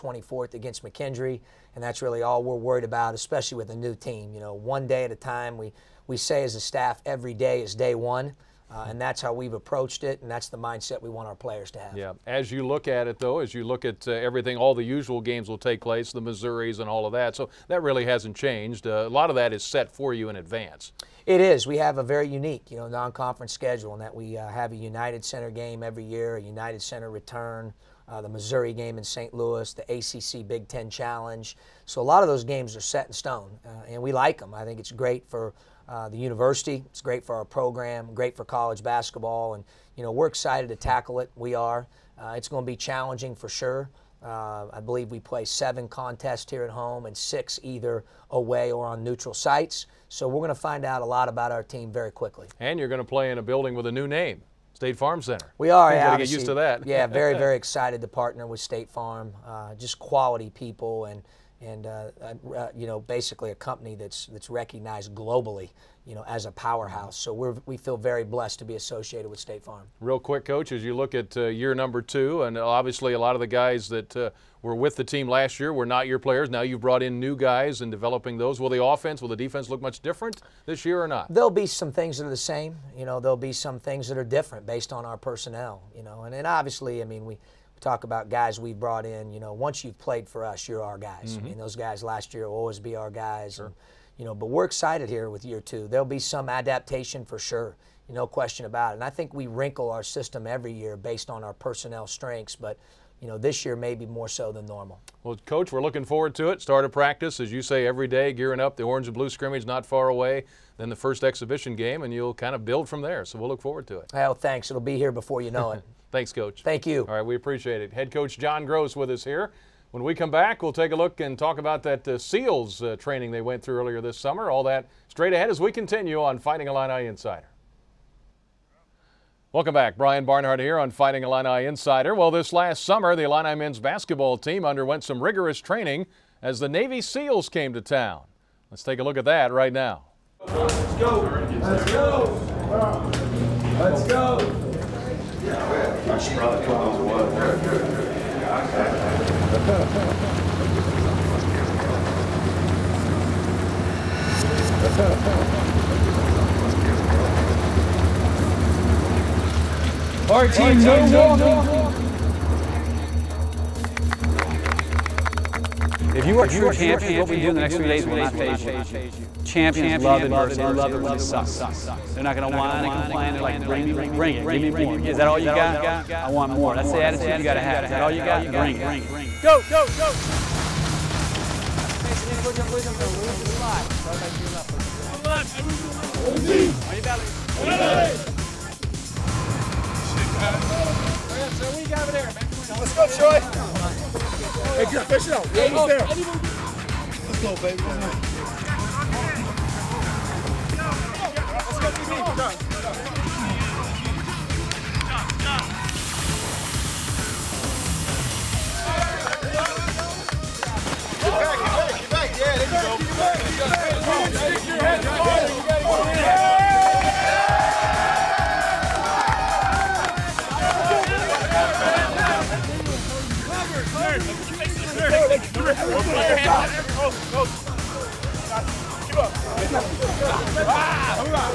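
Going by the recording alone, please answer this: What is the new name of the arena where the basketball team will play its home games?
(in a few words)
State Farm Center.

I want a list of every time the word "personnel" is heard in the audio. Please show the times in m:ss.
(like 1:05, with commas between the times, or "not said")
1:25, 1:41.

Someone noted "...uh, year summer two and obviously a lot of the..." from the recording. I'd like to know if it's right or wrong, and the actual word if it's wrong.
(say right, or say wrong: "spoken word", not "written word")
wrong: "number", not "summer".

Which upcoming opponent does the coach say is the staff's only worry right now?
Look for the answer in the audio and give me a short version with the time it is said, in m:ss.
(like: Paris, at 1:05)
McKendree, at 0:00.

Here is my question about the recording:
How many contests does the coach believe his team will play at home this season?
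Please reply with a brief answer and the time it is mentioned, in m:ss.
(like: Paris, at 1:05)
7, at 0:45.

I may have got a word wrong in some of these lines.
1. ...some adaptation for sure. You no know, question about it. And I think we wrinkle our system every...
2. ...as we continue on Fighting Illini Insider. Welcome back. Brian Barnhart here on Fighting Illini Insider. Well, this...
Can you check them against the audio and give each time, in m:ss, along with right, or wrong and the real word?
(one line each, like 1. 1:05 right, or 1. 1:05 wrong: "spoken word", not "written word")
1. 1:36 right
2. 2:05 right.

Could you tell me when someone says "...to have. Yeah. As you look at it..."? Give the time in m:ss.
0:11.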